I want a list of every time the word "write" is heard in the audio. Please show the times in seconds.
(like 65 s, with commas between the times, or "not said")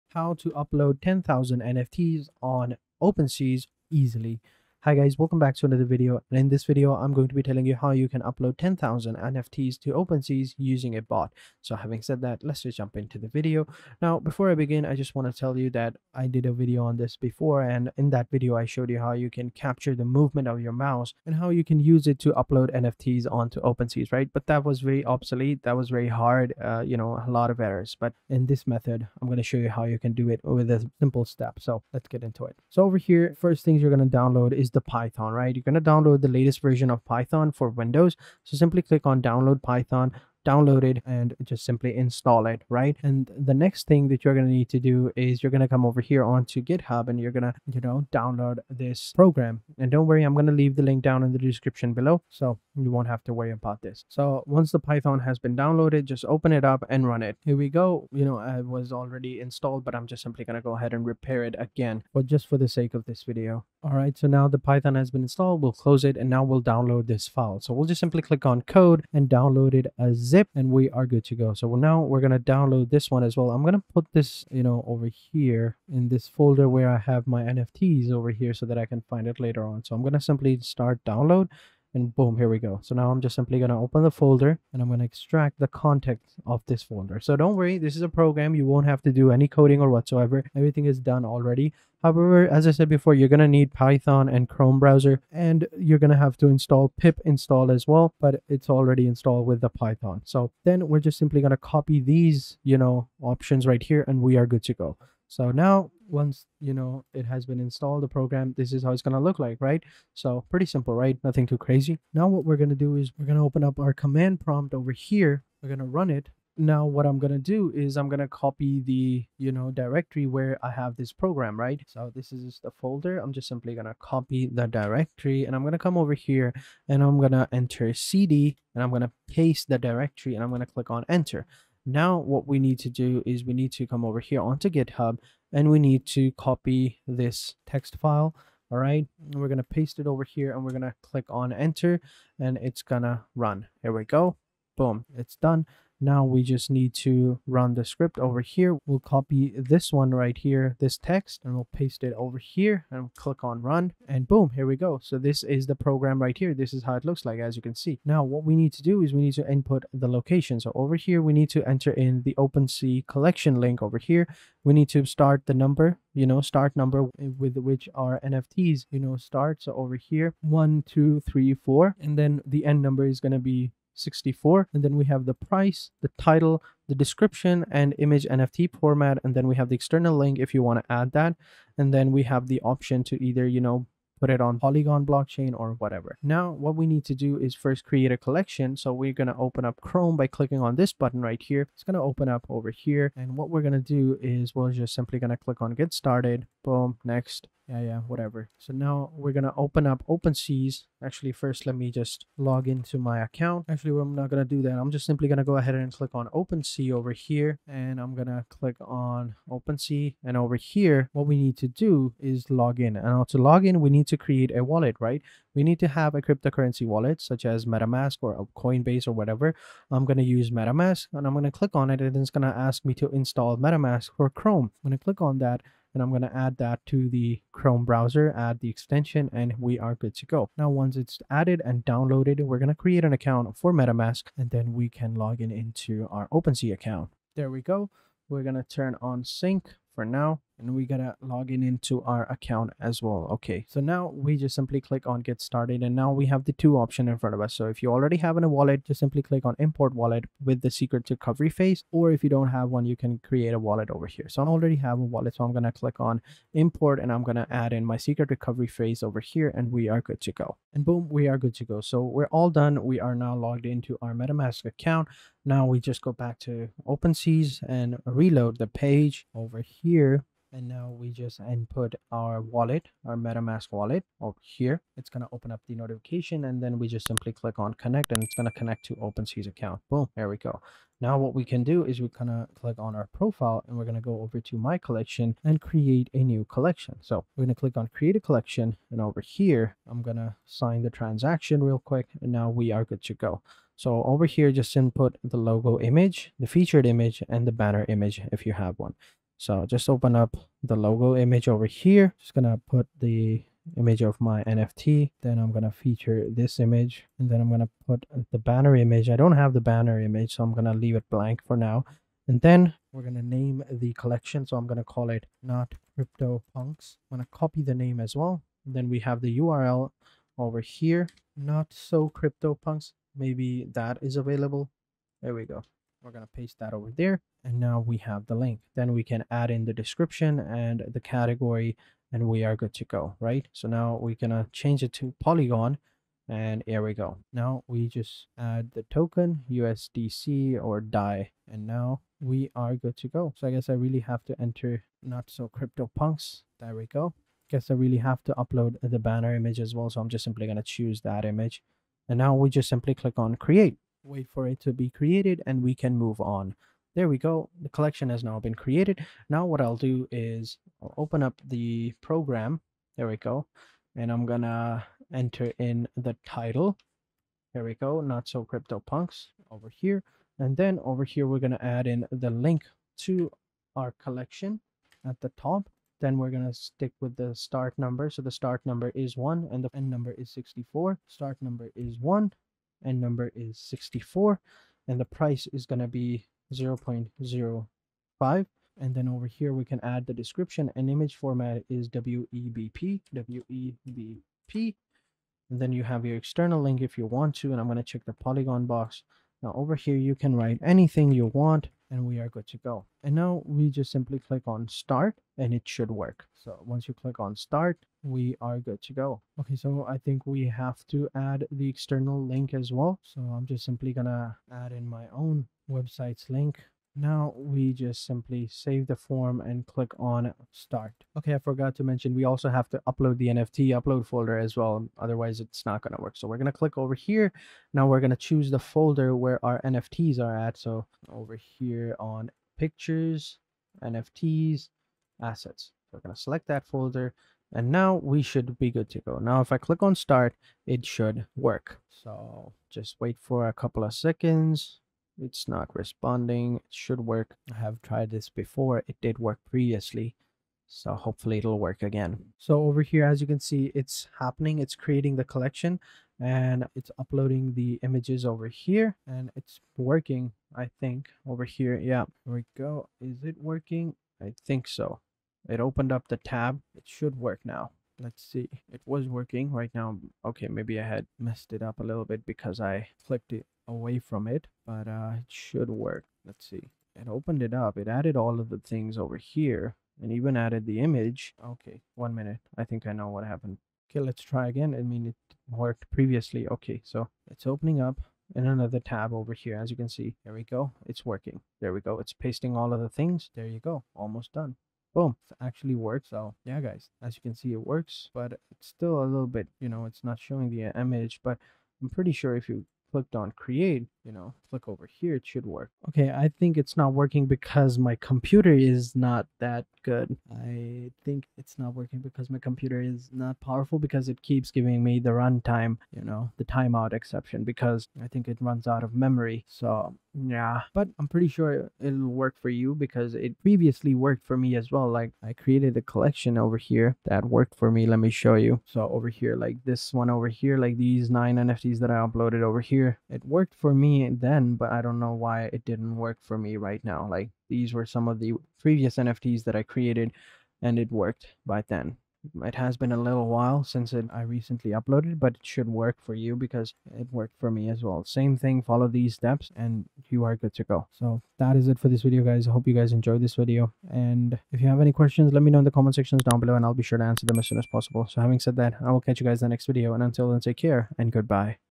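400 s.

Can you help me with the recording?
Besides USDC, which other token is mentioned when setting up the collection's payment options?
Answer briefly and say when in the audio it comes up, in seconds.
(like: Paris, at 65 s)
DAI, at 340 s.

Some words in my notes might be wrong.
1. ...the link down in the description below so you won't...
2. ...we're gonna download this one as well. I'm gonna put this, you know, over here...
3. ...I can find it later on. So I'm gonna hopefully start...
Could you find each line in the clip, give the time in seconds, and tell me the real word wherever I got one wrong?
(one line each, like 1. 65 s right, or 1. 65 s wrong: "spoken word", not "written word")
1. 50 s right
2. 72 s right
3. 78 s wrong: "simply", not "hopefully".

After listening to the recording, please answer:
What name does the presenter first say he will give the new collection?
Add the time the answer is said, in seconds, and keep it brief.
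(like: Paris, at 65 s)
not crypto punks, at 315 s.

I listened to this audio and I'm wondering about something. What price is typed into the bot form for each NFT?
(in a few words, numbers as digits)
0.05.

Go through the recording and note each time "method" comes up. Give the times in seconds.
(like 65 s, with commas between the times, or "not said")
28 s.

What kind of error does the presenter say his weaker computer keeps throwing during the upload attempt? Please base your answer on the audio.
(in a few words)
timeout exception.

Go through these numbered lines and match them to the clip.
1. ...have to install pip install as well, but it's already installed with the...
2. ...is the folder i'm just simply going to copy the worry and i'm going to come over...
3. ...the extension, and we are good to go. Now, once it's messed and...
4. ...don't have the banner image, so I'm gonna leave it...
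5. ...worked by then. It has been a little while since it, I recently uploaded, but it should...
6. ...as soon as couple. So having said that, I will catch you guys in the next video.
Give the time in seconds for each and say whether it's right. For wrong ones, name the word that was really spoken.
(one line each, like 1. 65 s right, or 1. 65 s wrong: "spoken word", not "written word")
1. 96 s right
2. 122 s wrong: "directory", not "worry"
3. 228 s wrong: "added", not "messed"
4. 309 s right
5. 540 s right
6. 557 s wrong: "possible", not "couple".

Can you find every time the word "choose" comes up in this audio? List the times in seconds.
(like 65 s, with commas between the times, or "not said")
350 s, 428 s.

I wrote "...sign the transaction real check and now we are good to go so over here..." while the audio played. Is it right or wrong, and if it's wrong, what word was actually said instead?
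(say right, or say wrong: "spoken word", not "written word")
wrong: "quick", not "check".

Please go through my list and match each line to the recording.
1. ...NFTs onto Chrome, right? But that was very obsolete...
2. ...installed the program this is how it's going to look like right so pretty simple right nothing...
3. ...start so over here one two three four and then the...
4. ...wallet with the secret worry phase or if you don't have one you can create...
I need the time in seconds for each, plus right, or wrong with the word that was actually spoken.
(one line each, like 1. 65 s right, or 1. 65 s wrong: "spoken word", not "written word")
1. 22 s wrong: "OpenSea", not "Chrome"
2. 107 s right
3. 169 s right
4. 249 s wrong: "recovery", not "worry".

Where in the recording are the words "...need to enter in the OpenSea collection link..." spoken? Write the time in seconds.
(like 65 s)
161 s.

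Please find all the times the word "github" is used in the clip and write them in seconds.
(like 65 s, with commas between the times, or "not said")
46 s, 134 s.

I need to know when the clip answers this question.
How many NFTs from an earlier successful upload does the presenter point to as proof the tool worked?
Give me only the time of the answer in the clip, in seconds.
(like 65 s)
531 s.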